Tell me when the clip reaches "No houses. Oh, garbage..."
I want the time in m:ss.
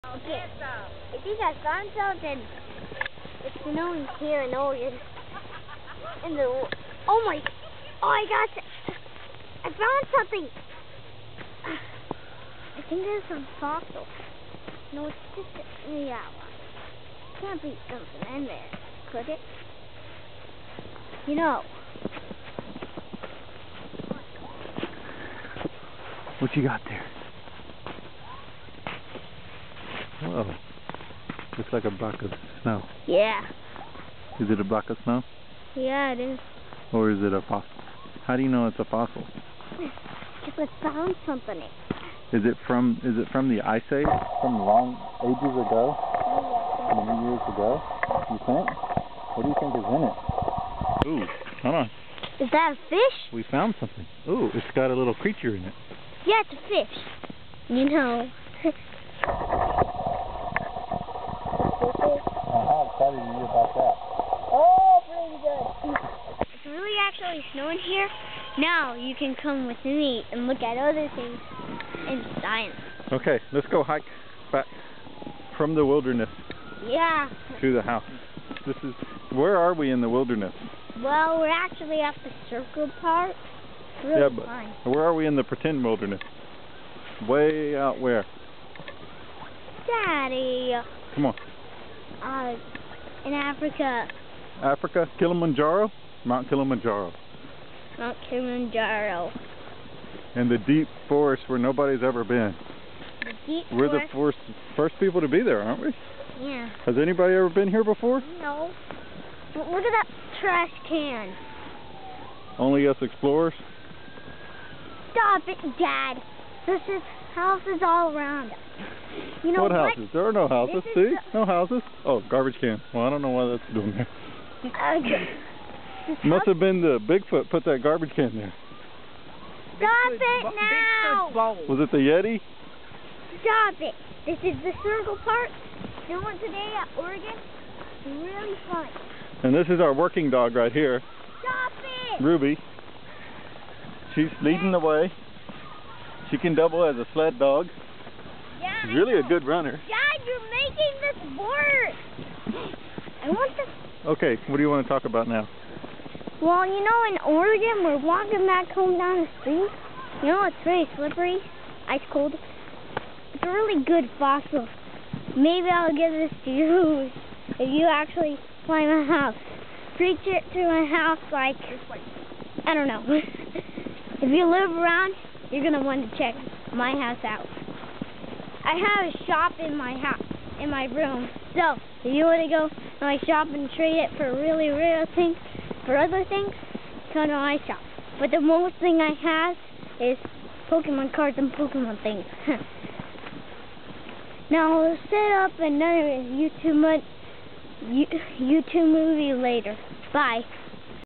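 2:01.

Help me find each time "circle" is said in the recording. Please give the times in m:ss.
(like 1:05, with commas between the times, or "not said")
1:22, 2:14.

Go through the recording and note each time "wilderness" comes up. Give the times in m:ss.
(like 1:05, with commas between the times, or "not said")
1:15, 1:20, 1:25.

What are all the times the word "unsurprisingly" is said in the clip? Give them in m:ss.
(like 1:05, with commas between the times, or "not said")
not said.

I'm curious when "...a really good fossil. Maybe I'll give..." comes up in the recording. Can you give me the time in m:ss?
2:43.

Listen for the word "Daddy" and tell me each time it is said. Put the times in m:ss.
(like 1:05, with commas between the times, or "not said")
1:29.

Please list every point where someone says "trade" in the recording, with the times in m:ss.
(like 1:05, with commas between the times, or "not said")
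3:03.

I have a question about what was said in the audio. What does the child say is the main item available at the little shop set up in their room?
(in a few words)
Pokemon cards.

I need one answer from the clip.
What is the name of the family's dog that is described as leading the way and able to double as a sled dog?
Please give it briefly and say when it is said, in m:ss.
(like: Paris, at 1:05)
Ruby, at 2:22.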